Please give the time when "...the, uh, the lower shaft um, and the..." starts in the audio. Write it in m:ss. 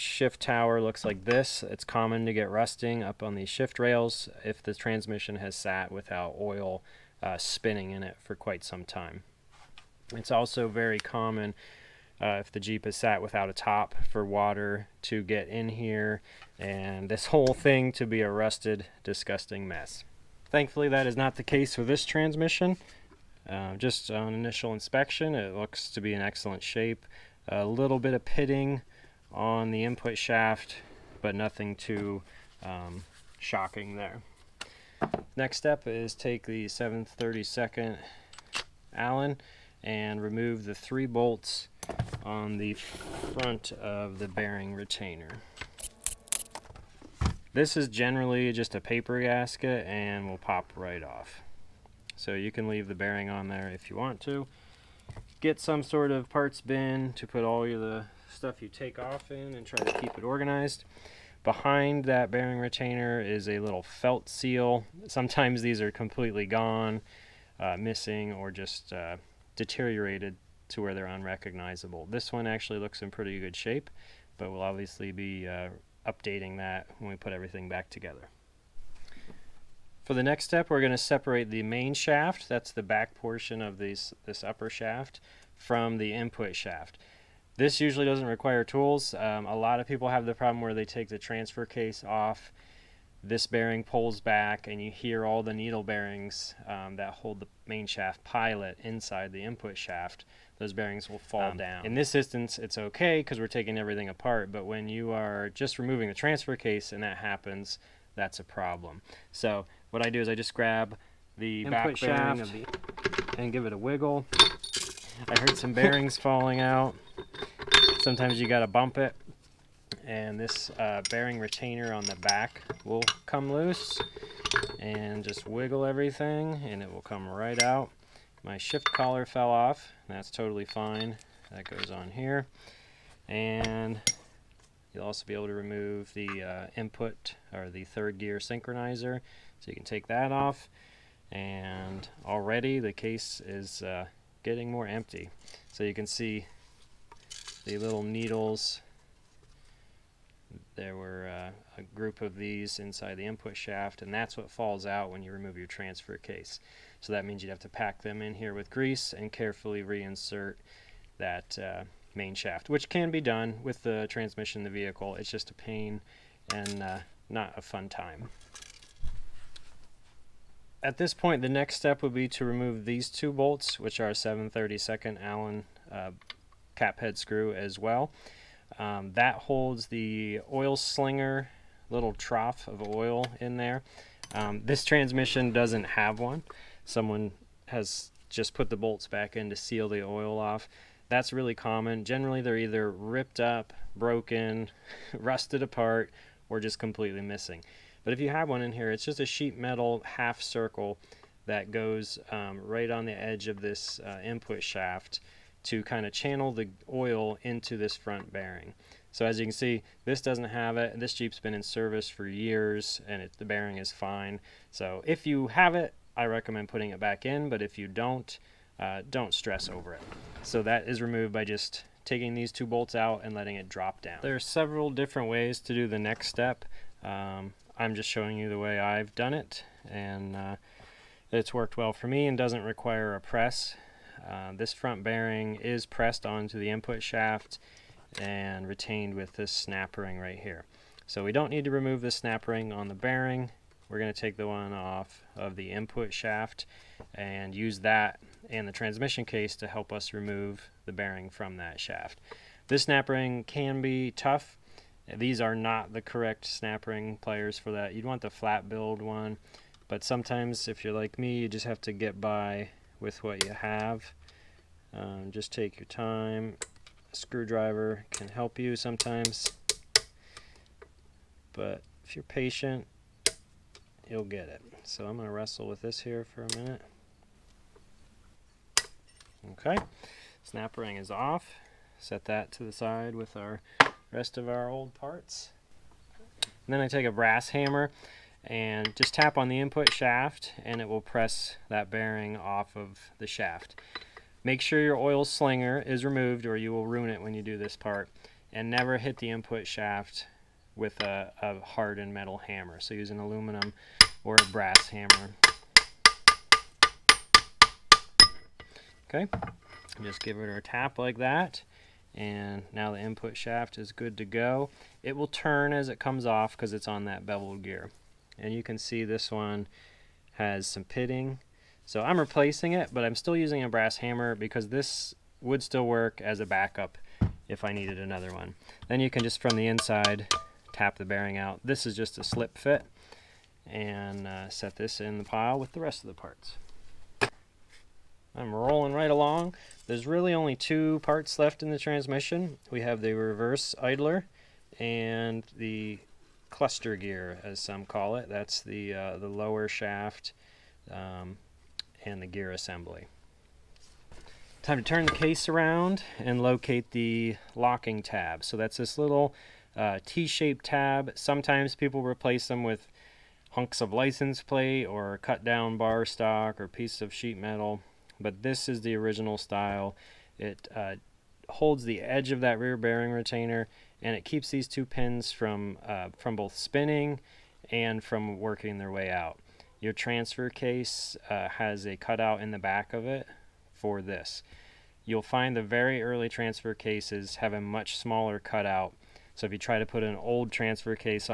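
5:48.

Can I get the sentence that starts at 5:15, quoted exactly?
It will turn as it comes off because it's on that beveled gear.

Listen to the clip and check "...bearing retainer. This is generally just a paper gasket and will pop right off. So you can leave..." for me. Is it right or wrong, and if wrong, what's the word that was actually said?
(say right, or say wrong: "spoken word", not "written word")
right.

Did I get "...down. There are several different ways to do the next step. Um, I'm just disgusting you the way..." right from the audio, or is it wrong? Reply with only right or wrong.
wrong.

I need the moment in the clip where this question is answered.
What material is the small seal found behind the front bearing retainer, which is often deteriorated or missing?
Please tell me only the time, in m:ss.
1:03.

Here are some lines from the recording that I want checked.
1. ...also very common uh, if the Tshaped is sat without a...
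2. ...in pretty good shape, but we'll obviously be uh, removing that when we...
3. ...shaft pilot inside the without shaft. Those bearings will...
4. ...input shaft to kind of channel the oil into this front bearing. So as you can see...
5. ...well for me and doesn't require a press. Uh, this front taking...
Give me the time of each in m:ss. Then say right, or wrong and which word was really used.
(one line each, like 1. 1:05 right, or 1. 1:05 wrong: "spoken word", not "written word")
1. 0:10 wrong: "Jeep", not "Tshaped"
2. 1:13 wrong: "updating", not "removing"
3. 1:37 wrong: "input", not "without"
4. 3:24 right
5. 3:51 wrong: "bearing", not "taking".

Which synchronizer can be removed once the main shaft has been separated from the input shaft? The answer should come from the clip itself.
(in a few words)
Third gear synchronizer.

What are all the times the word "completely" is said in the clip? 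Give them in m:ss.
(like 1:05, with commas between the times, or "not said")
1:05, 3:16.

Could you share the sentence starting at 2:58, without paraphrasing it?
Um, that holds the oil slinger little trough of oil in there.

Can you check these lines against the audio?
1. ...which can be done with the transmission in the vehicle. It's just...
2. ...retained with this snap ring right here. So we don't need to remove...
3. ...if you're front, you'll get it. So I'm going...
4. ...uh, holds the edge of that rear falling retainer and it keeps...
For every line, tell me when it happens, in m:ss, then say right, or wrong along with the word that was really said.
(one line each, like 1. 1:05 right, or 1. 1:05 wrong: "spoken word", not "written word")
1. 2:42 right
2. 3:58 right
3. 4:32 wrong: "patient", not "front"
4. 6:10 wrong: "bearing", not "falling".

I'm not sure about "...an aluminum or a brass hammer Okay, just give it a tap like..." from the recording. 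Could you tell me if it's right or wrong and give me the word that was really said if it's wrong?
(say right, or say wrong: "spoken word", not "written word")
right.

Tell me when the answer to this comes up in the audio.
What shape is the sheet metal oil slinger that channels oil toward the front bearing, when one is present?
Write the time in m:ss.
3:20.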